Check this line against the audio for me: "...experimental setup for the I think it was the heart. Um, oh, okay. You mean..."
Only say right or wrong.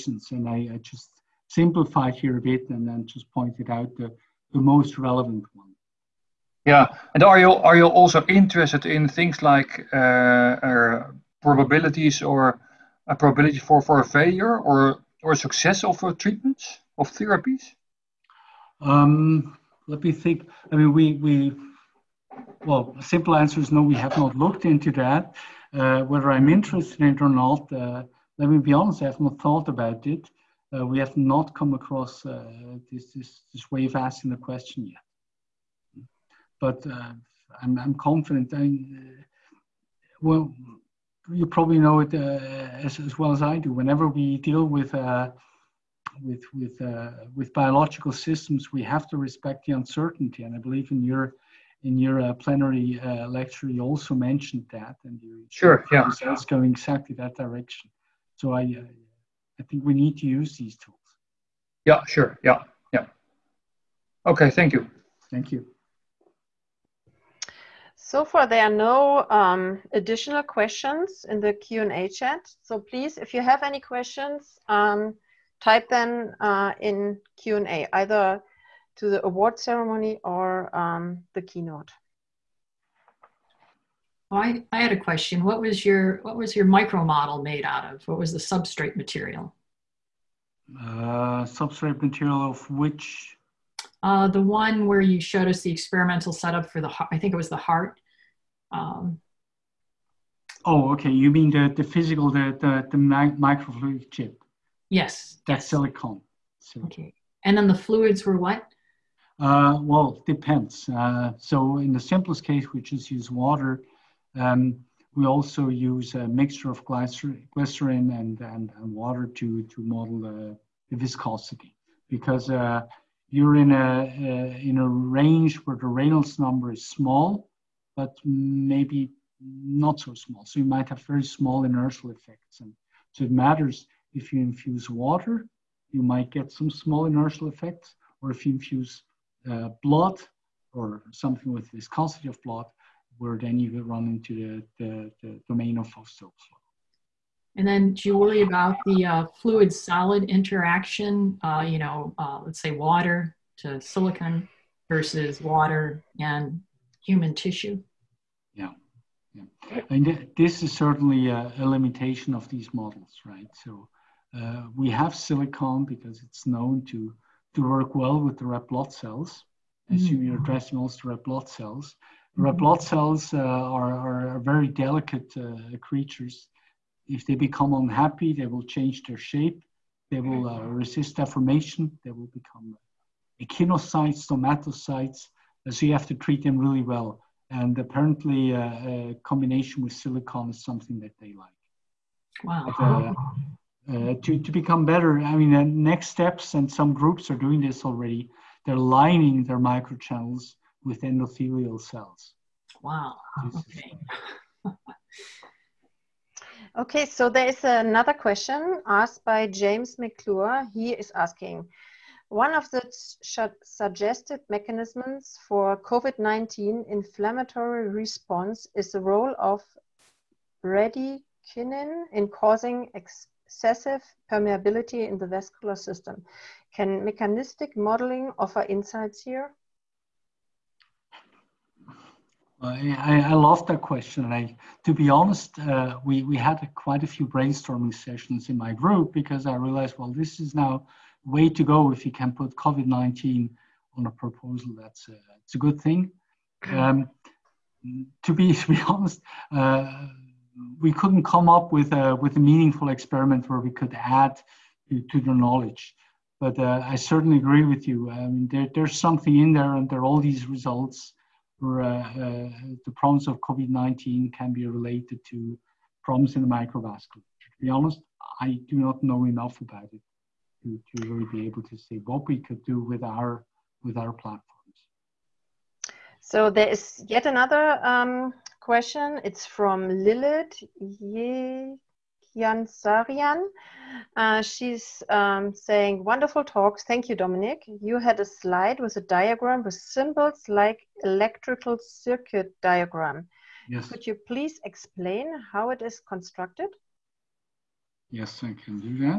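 right.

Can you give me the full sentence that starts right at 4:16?
But uh, I certainly agree with you.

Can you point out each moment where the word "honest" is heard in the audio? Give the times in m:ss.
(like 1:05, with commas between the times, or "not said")
0:28, 3:55, 4:08, 4:27.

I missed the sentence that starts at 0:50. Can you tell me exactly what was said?
And I believe in your in your plenary lecture, you also mentioned that, and you sure, yeah, it's going exactly that direction.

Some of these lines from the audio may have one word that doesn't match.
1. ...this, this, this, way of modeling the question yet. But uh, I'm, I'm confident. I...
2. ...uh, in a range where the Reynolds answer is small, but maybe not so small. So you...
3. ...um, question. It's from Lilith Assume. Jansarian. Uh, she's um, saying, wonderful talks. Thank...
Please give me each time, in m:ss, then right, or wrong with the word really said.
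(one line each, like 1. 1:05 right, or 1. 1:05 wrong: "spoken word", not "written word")
1. 0:32 wrong: "asking", not "modeling"
2. 2:04 wrong: "number", not "answer"
3. 4:37 wrong: "Yeah", not "Assume".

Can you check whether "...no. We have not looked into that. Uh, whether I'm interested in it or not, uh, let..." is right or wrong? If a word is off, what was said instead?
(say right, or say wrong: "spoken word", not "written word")
right.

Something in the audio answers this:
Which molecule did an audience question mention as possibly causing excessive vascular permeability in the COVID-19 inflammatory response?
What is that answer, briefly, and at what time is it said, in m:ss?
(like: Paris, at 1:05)
Bradykinin, at 3:40.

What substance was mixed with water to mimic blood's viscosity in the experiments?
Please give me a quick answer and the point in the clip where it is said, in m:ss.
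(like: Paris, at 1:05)
Glycerin, at 1:56.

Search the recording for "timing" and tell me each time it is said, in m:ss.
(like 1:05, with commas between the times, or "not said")
not said.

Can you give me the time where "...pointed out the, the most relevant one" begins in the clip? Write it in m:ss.
0:03.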